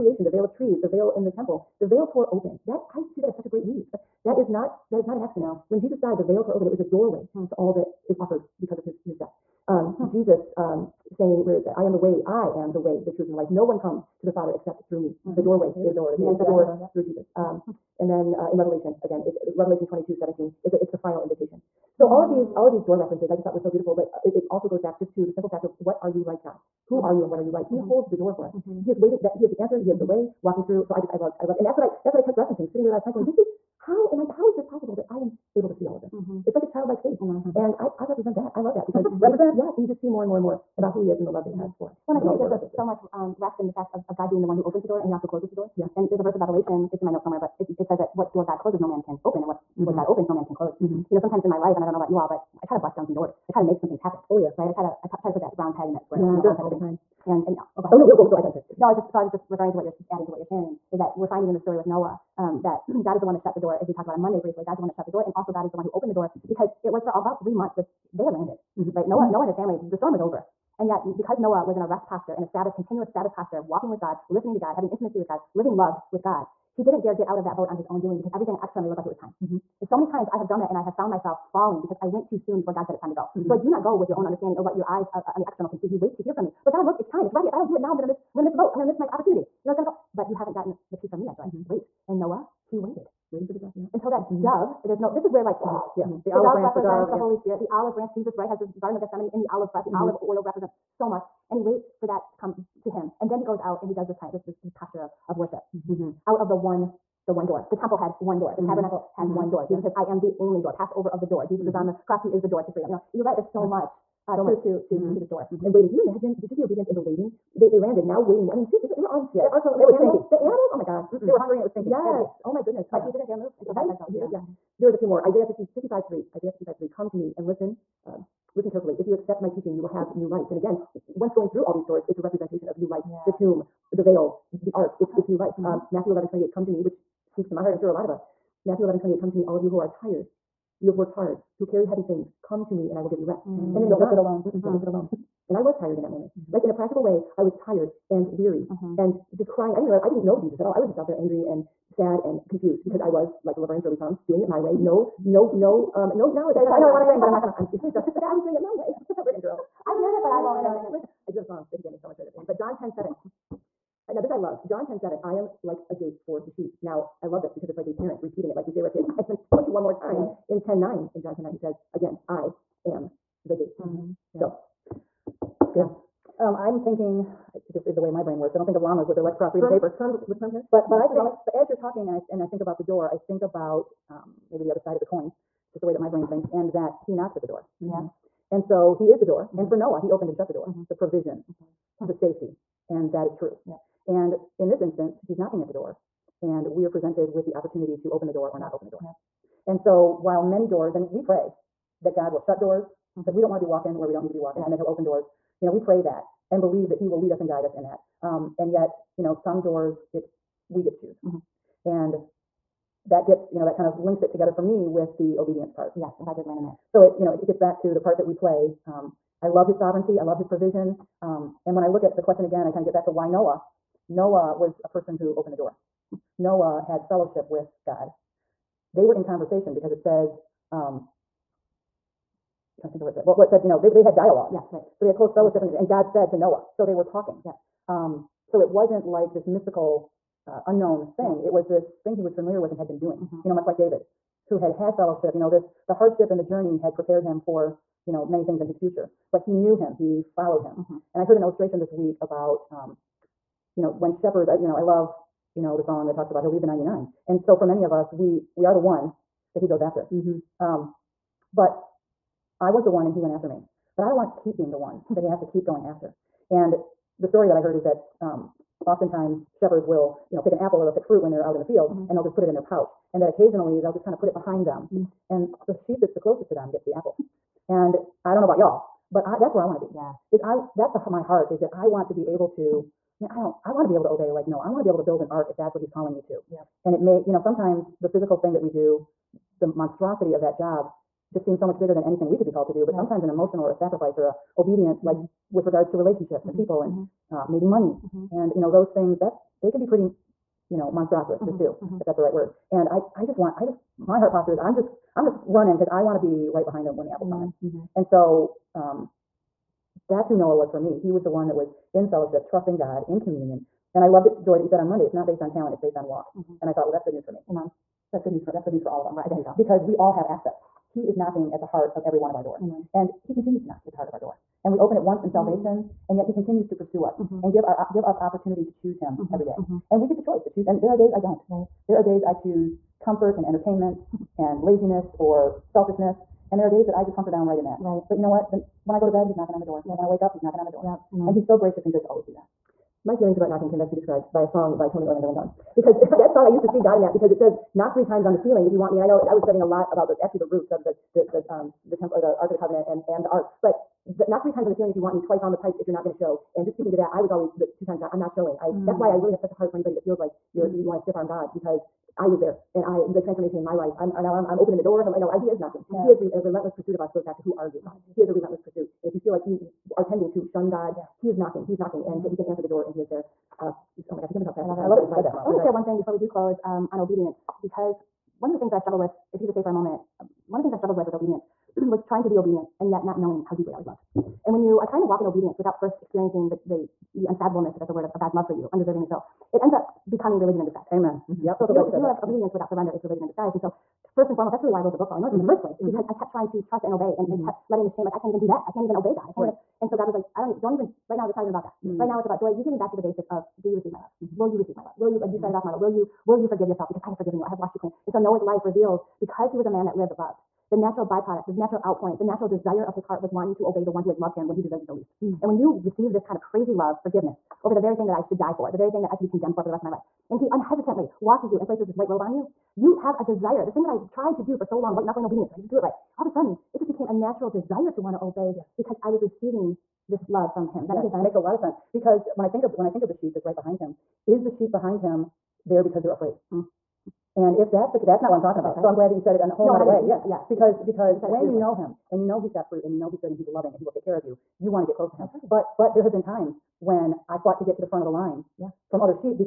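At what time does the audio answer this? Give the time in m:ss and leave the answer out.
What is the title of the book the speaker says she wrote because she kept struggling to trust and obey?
6:35.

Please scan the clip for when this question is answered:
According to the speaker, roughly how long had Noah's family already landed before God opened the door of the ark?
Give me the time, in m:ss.
1:07.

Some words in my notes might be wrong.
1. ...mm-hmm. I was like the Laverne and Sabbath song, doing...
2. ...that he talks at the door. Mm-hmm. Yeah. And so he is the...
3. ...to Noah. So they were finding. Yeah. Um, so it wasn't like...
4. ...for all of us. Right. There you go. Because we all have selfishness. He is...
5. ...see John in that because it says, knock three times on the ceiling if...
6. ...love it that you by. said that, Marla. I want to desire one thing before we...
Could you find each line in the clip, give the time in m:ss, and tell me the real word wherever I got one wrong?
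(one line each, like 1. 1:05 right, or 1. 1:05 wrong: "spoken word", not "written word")
1. 2:32 wrong: "Shirley", not "Sabbath"
2. 3:06 wrong: "knocks", not "talks"
3. 3:56 wrong: "talking", not "finding"
4. 5:18 wrong: "access", not "selfishness"
5. 5:46 wrong: "God", not "John"
6. 6:14 wrong: "share", not "desire".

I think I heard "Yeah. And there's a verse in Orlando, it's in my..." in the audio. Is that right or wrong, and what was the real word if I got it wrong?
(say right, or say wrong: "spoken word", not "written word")
wrong: "Revelation", not "Orlando".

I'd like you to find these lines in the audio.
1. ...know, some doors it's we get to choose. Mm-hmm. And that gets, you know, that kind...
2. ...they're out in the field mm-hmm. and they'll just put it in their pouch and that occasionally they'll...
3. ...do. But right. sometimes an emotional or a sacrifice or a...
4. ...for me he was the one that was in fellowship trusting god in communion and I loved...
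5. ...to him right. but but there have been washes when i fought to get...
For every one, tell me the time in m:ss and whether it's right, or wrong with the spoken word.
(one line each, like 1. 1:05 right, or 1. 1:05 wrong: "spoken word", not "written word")
1. 3:29 right
2. 4:31 right
3. 4:52 right
4. 5:10 right
5. 7:25 wrong: "times", not "washes".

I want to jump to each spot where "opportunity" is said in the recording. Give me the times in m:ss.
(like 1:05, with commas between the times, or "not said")
1:29, 3:17, 5:28.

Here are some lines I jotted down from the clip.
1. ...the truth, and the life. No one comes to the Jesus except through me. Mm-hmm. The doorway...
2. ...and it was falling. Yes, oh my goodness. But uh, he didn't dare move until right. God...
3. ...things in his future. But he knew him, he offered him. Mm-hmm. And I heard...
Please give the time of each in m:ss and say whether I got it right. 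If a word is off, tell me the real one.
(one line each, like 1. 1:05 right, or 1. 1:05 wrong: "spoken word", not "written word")
1. 0:13 wrong: "Father", not "Jesus"
2. 2:01 wrong: "stinking", not "falling"
3. 4:08 wrong: "followed", not "offered".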